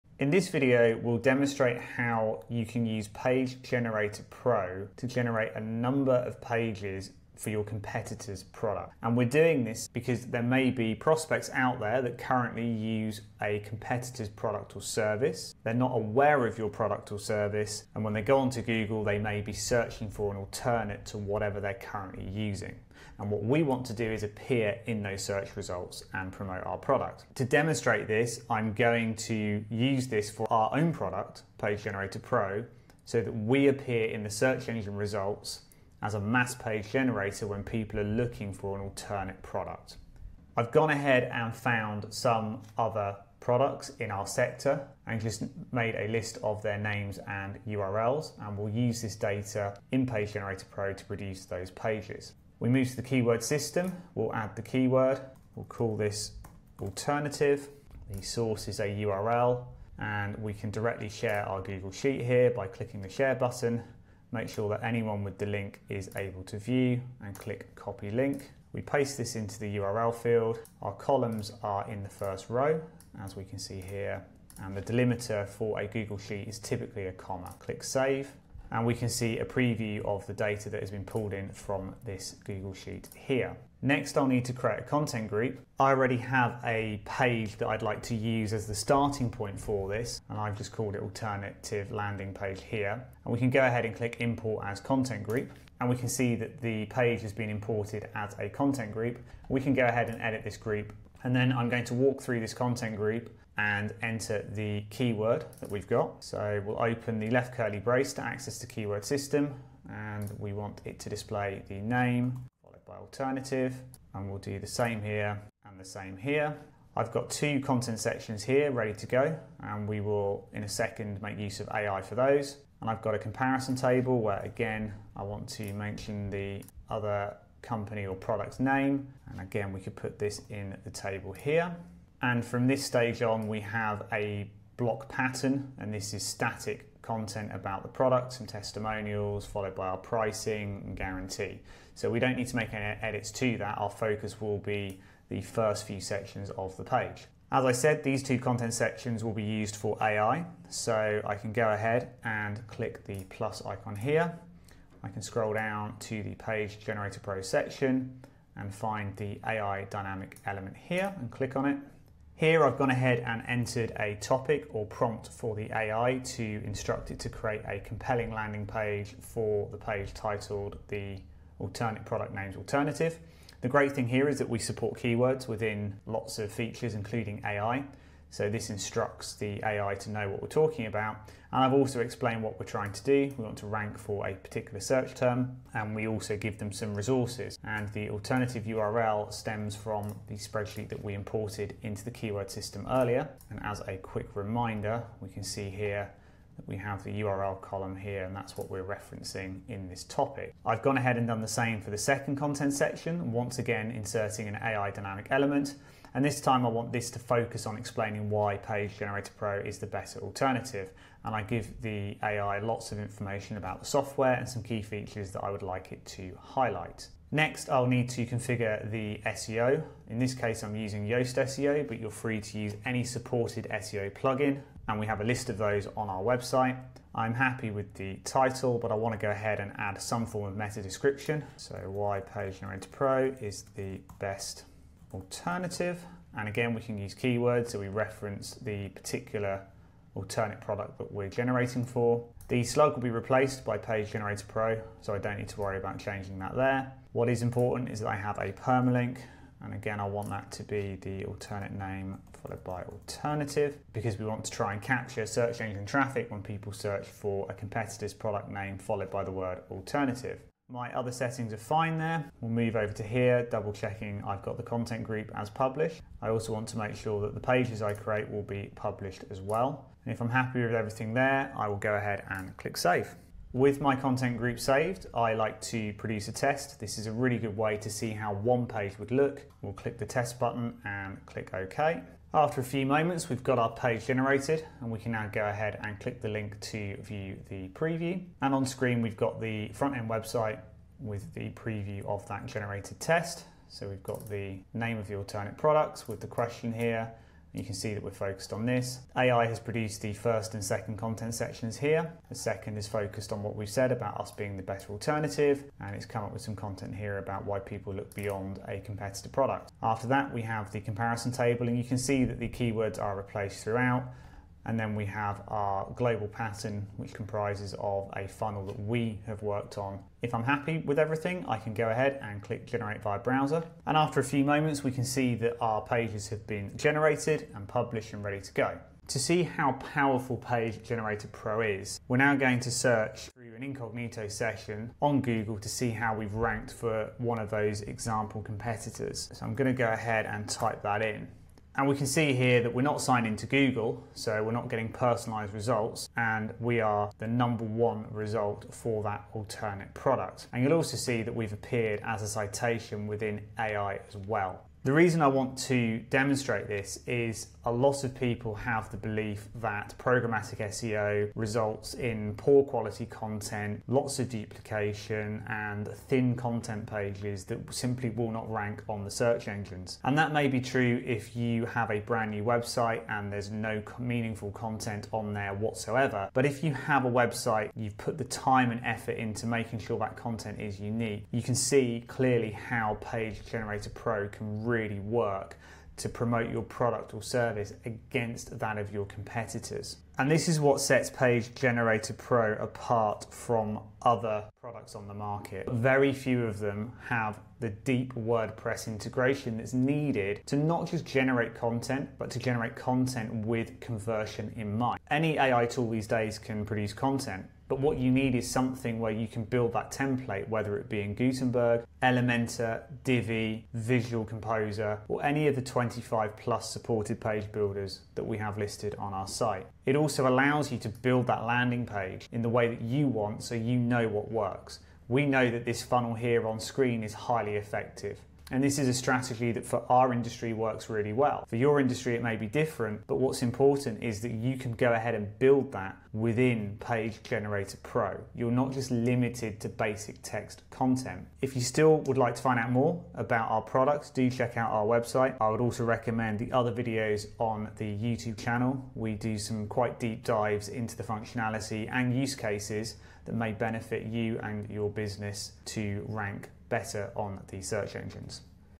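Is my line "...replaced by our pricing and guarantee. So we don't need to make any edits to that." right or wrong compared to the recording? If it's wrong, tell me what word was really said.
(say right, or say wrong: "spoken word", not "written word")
wrong: "followed", not "replaced".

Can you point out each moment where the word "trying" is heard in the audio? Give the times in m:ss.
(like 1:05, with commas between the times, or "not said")
3:02.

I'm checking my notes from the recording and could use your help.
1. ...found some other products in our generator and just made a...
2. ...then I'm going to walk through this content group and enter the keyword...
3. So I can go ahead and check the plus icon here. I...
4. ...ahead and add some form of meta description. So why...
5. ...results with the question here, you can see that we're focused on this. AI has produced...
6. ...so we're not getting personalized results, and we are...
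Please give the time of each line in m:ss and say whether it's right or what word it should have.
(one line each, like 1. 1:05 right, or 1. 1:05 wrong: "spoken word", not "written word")
1. 0:41 wrong: "sector", not "generator"
2. 1:41 right
3. 2:30 wrong: "click", not "check"
4. 3:49 right
5. 4:55 wrong: "products", not "results"
6. 5:44 right.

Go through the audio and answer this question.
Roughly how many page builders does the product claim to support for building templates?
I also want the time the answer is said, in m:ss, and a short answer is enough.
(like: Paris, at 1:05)
25+, at 6:55.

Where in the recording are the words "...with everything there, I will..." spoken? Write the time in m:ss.
4:30.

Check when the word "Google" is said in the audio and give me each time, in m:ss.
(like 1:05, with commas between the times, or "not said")
0:18, 1:01, 1:15, 1:22, 5:35, 5:43.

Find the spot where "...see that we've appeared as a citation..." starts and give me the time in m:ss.
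5:50.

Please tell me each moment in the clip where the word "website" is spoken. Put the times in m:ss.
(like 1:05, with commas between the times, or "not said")
3:46, 4:50, 6:12, 6:17, 7:24.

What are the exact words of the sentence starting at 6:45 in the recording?
Any AI tool these days can produce content.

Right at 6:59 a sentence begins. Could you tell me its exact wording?
It also allows you to build that landing page in the way that you want so you know what works.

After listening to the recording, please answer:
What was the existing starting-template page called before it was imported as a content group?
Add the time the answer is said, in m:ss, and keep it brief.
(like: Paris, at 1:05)
alternative landing page, at 1:31.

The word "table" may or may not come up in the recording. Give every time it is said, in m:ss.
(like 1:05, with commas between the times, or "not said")
2:03, 2:10, 5:11.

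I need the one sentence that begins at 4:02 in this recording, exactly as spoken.
The slug will be replaced by Page Generator Pro, so I don't need to worry about changing that there.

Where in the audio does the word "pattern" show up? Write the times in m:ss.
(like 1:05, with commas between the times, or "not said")
2:15, 5:16.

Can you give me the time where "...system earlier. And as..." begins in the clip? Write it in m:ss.
3:12.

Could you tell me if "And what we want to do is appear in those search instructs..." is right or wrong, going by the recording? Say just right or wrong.
wrong.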